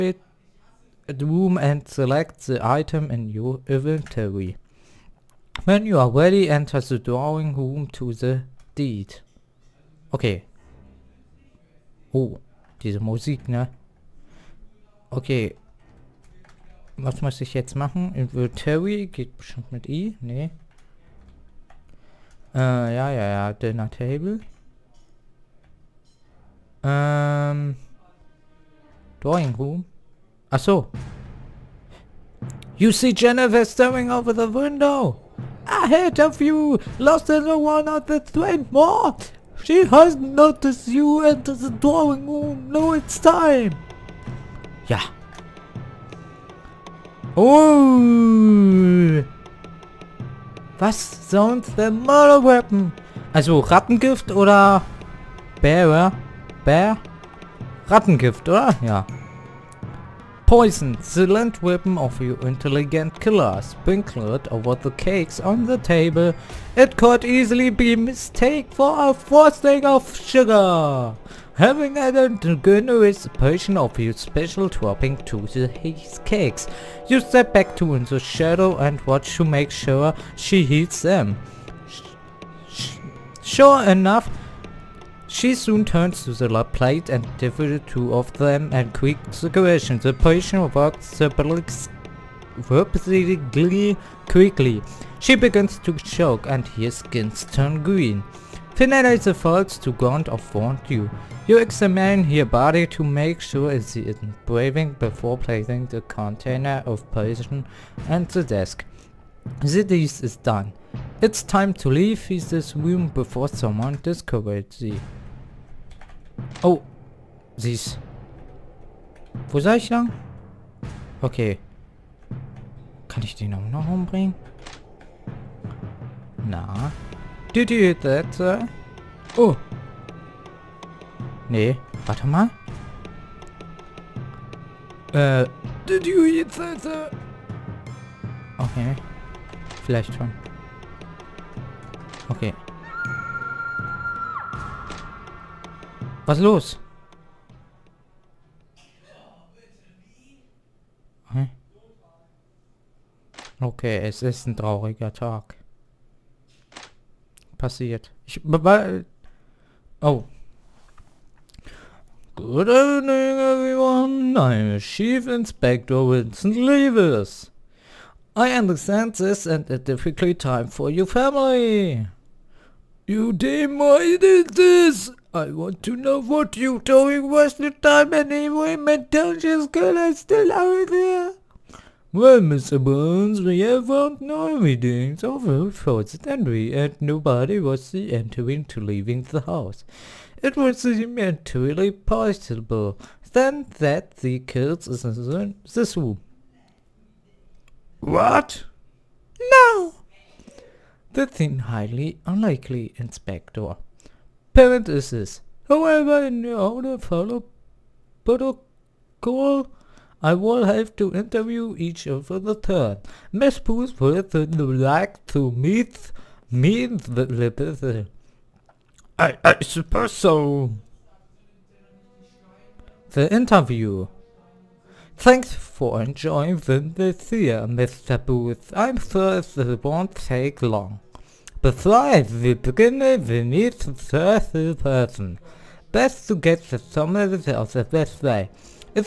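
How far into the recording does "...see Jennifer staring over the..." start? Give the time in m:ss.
0:32.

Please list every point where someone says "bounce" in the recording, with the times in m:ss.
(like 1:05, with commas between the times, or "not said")
not said.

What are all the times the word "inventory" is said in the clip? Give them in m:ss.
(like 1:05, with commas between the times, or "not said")
0:03, 0:18.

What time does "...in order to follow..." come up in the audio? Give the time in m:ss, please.
3:26.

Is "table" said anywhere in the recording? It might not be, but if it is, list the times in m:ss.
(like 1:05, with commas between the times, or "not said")
0:23, 1:05.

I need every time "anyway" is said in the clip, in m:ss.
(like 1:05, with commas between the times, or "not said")
2:58.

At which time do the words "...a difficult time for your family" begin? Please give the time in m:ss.
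2:49.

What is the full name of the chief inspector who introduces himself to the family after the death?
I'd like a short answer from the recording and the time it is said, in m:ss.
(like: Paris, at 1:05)
Vincent Leavis, at 2:45.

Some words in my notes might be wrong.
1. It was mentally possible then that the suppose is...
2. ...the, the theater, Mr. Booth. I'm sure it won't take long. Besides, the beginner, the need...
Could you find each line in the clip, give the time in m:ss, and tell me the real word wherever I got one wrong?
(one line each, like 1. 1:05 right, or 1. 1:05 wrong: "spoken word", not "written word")
1. 3:10 wrong: "curse", not "suppose"
2. 3:46 right.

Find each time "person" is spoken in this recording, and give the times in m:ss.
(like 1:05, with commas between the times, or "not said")
3:37, 3:54.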